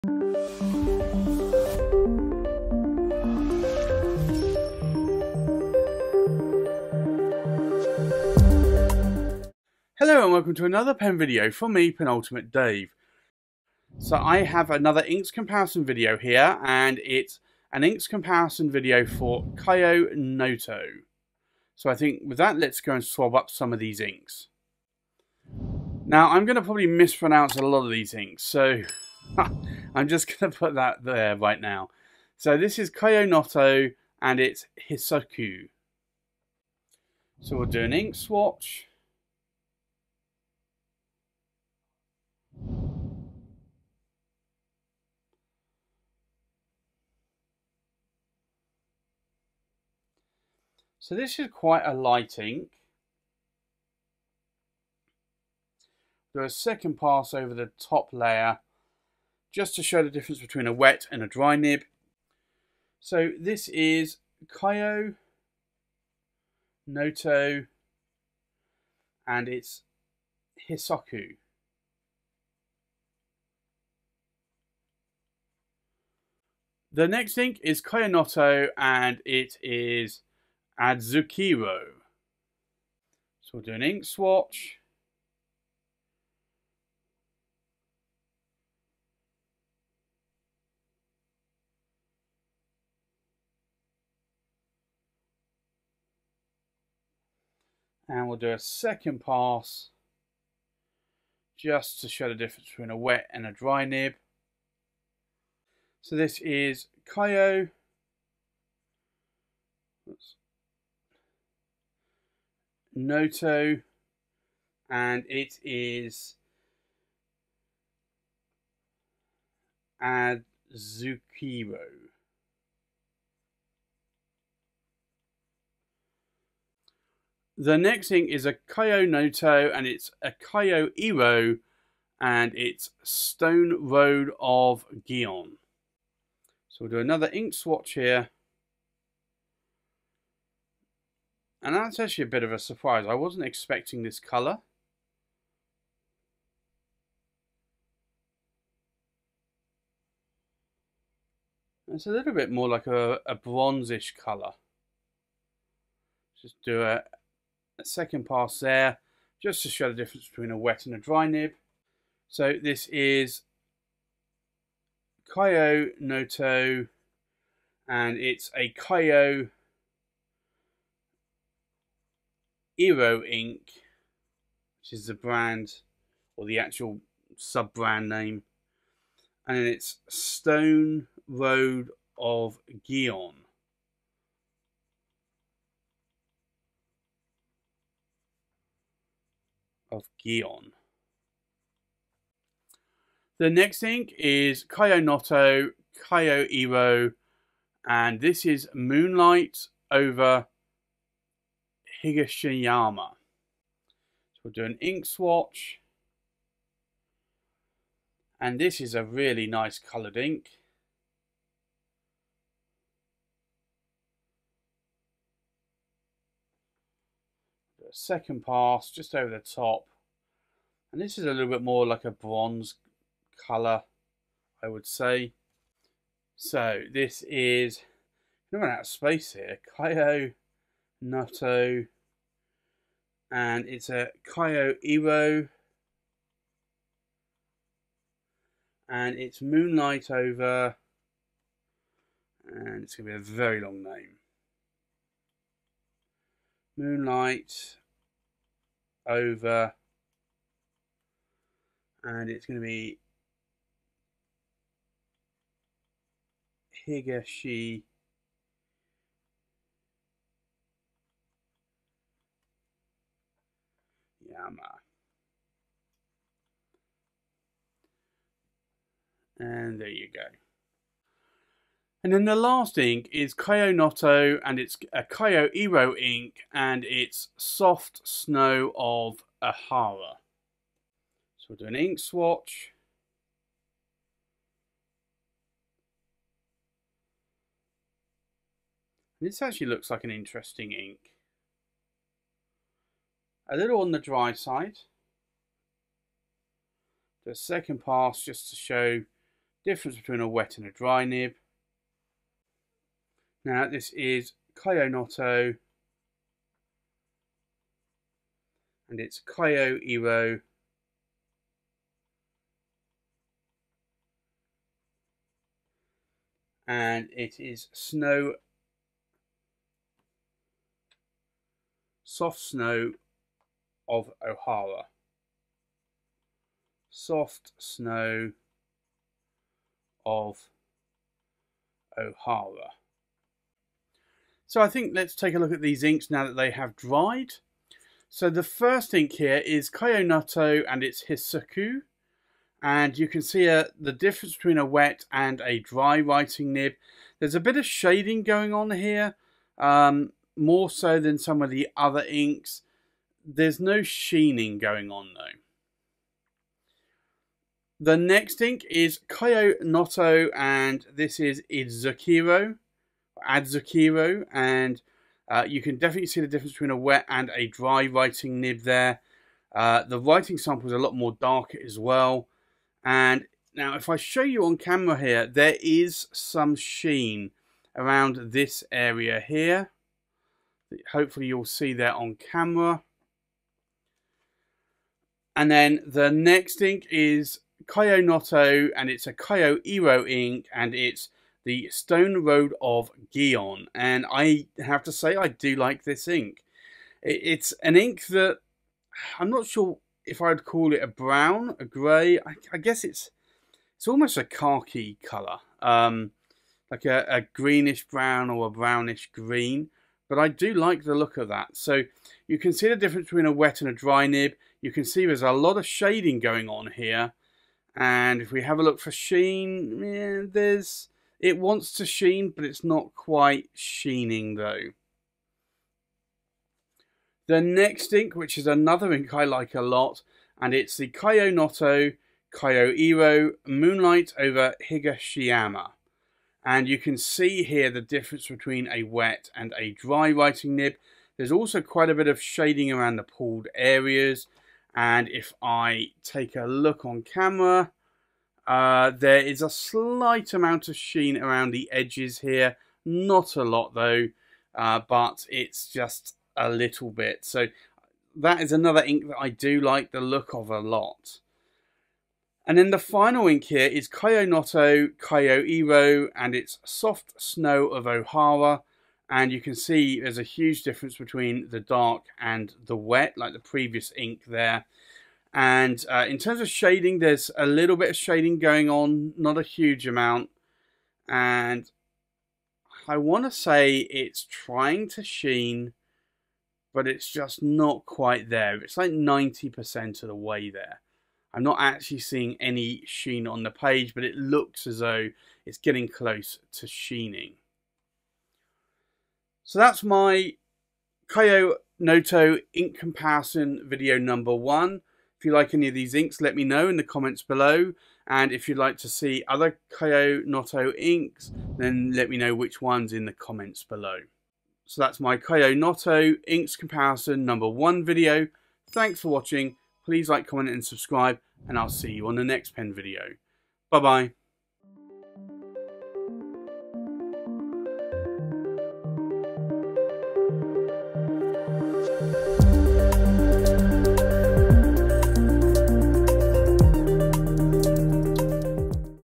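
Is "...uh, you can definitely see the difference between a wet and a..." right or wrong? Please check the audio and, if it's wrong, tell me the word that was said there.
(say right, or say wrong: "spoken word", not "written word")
right.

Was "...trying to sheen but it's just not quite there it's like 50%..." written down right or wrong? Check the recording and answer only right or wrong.
wrong.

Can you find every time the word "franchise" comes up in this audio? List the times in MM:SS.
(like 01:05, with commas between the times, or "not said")
not said.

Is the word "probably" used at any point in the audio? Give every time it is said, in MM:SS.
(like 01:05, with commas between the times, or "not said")
00:26.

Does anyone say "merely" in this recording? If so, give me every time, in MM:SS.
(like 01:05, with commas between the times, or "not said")
not said.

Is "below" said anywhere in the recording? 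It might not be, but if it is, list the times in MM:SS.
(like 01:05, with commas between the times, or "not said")
08:27, 08:33.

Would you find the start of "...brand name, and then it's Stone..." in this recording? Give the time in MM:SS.
02:57.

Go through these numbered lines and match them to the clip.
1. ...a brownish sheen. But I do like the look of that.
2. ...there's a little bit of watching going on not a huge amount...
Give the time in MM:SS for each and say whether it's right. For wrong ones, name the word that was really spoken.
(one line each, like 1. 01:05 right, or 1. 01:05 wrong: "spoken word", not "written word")
1. 06:48 wrong: "green", not "sheen"
2. 07:56 wrong: "shading", not "watching".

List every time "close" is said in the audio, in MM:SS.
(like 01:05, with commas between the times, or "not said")
08:15.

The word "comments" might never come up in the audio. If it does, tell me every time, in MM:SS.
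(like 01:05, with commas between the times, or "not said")
08:26, 08:33, 08:40.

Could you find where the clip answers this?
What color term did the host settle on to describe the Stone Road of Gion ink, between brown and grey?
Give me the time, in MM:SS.
06:44.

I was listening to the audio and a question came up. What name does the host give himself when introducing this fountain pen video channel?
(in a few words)
Penultimate Dave.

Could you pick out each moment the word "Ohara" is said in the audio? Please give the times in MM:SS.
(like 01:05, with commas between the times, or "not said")
05:24, 05:31, 07:47.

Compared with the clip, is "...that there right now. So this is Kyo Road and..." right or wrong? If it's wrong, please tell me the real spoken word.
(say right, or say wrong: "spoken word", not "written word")
wrong: "Noto", not "Road".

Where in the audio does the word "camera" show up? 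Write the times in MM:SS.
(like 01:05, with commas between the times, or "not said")
06:14, 06:22, 07:27.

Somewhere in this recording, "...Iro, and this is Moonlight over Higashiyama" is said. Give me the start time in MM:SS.
03:16.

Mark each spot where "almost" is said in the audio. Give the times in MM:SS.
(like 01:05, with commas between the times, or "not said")
06:43.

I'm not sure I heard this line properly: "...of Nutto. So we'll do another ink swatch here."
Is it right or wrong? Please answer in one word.
wrong.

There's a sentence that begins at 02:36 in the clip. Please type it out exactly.
Just do a, a second pass there, just to show the difference between a wet and a dry nib.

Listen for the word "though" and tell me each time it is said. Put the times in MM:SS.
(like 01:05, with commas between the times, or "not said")
05:55, 07:04, 07:33, 08:14.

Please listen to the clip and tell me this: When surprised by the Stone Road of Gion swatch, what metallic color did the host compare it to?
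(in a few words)
bronzish.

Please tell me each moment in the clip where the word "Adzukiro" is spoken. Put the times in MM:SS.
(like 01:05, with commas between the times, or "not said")
01:20, 02:00, 06:03.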